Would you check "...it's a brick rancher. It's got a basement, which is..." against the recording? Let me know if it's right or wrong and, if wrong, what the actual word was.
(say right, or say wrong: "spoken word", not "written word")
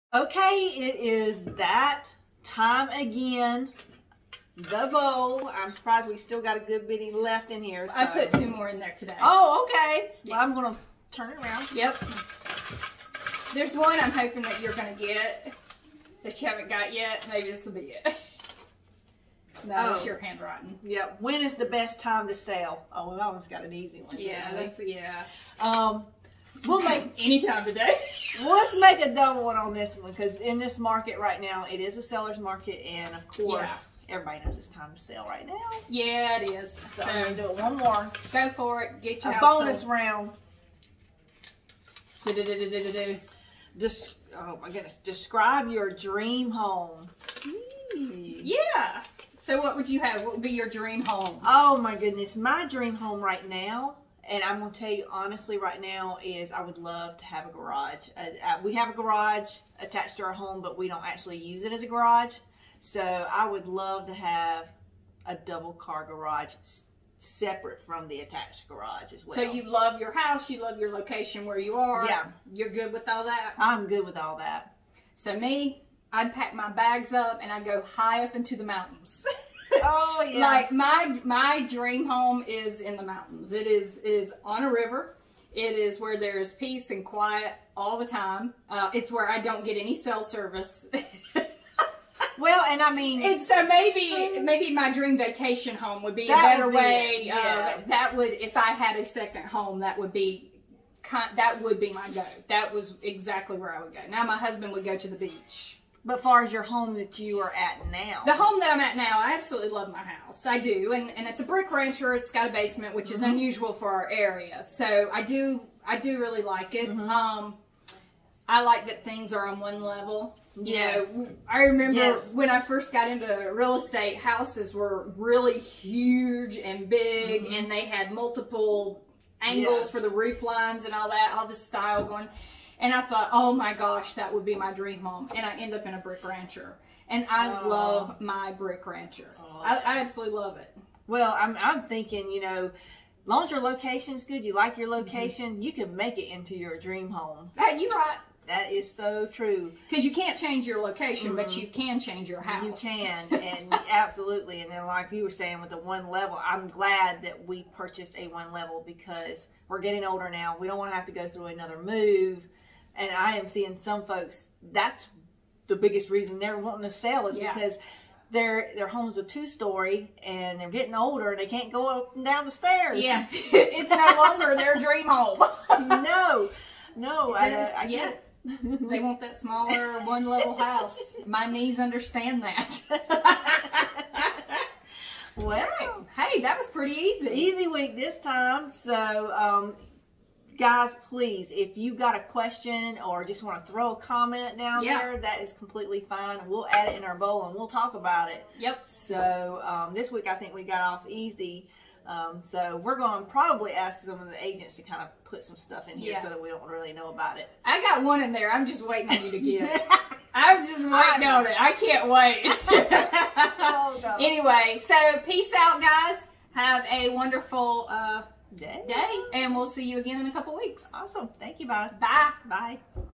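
right.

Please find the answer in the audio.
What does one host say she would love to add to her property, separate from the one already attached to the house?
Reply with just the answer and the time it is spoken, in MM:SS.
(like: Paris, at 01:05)
double car garage, at 01:05.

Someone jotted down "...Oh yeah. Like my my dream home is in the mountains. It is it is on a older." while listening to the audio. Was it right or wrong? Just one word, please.
wrong.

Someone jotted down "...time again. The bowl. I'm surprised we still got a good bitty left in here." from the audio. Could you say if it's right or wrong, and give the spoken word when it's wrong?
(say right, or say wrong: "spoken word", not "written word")
right.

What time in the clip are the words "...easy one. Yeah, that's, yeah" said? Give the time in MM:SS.
00:23.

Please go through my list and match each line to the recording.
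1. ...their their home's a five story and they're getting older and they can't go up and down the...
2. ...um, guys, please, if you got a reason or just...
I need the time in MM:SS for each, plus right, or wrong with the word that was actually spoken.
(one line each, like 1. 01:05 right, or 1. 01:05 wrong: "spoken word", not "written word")
1. 02:48 wrong: "two", not "five"
2. 03:09 wrong: "question", not "reason".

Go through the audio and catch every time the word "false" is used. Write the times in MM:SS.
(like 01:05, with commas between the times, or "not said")
not said.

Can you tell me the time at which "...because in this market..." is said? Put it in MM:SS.
00:30.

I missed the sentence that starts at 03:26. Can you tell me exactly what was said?
so that we don't really know about it.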